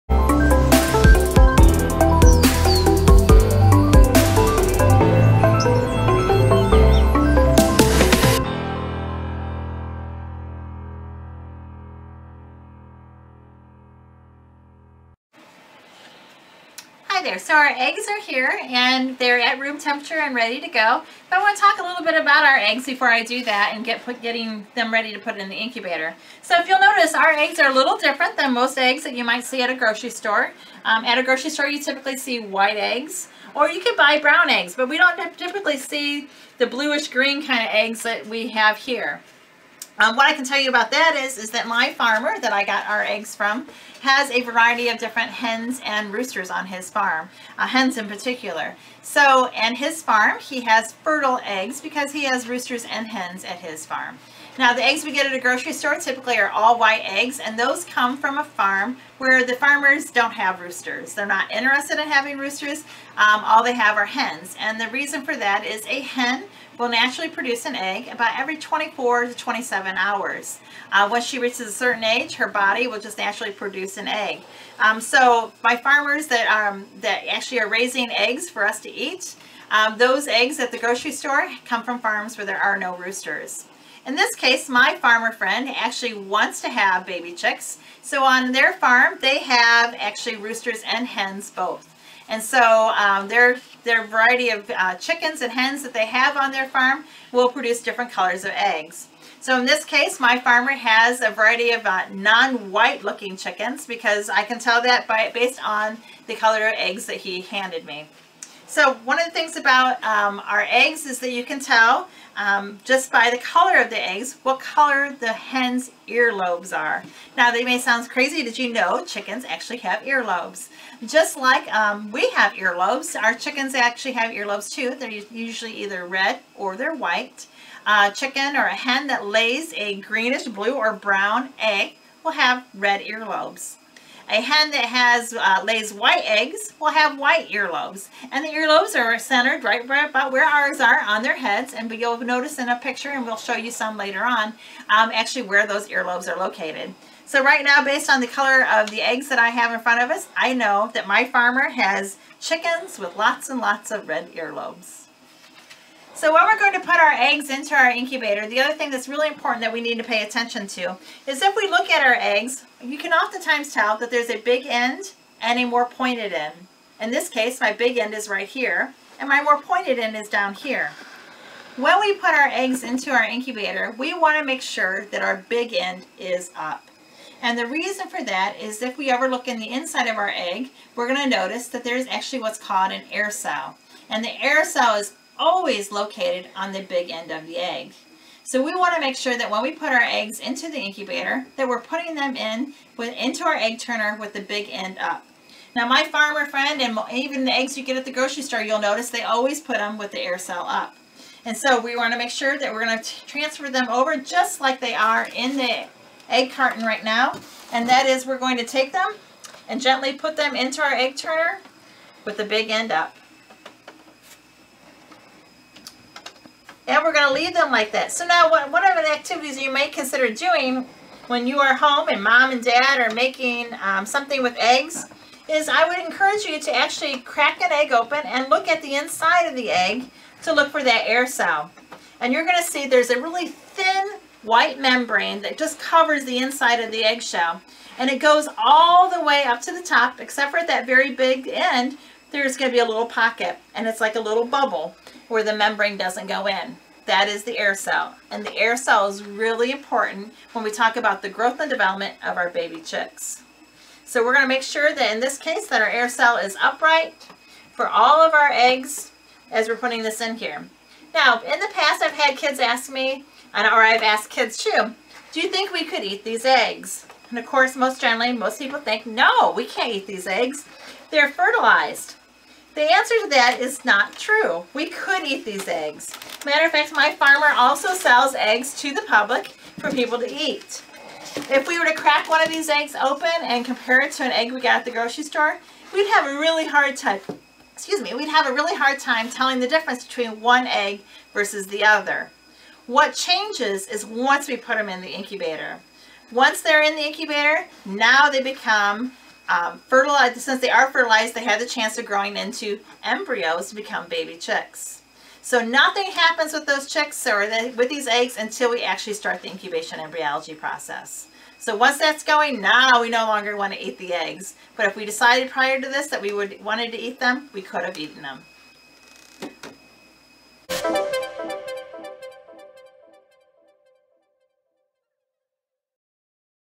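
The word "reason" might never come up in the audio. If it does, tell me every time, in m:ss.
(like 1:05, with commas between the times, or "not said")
1:04, 2:57.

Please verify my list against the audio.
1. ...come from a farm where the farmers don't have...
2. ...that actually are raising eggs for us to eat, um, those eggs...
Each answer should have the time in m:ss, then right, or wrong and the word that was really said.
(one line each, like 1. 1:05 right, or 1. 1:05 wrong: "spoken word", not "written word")
1. 0:57 right
2. 1:16 right.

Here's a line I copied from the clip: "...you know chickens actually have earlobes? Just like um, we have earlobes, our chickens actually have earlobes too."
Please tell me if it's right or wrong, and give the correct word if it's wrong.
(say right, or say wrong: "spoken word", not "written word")
right.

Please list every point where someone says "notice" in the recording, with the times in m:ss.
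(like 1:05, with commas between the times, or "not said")
0:26, 2:22, 3:01, 3:18.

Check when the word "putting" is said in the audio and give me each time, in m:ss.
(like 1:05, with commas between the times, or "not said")
3:11, 4:19.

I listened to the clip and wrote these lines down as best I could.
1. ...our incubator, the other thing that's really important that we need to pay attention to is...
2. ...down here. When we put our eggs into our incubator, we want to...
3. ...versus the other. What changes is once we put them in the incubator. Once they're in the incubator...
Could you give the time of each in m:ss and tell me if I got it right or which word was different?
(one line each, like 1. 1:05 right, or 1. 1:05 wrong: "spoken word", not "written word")
1. 2:37 right
2. 2:50 right
3. 4:51 right.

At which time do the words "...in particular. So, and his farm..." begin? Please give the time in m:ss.
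0:47.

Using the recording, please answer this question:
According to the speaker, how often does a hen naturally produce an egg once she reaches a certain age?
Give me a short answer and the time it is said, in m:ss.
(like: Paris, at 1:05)
every 24 to 27 hours, at 1:08.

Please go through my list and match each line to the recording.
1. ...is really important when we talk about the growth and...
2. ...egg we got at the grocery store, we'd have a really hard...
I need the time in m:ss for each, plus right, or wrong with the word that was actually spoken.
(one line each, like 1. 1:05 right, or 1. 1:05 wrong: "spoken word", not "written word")
1. 4:09 right
2. 4:44 right.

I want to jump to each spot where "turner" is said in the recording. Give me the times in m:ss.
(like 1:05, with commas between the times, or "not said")
3:13, 3:31.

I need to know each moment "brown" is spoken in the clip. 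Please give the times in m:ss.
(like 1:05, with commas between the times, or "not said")
0:34, 2:10.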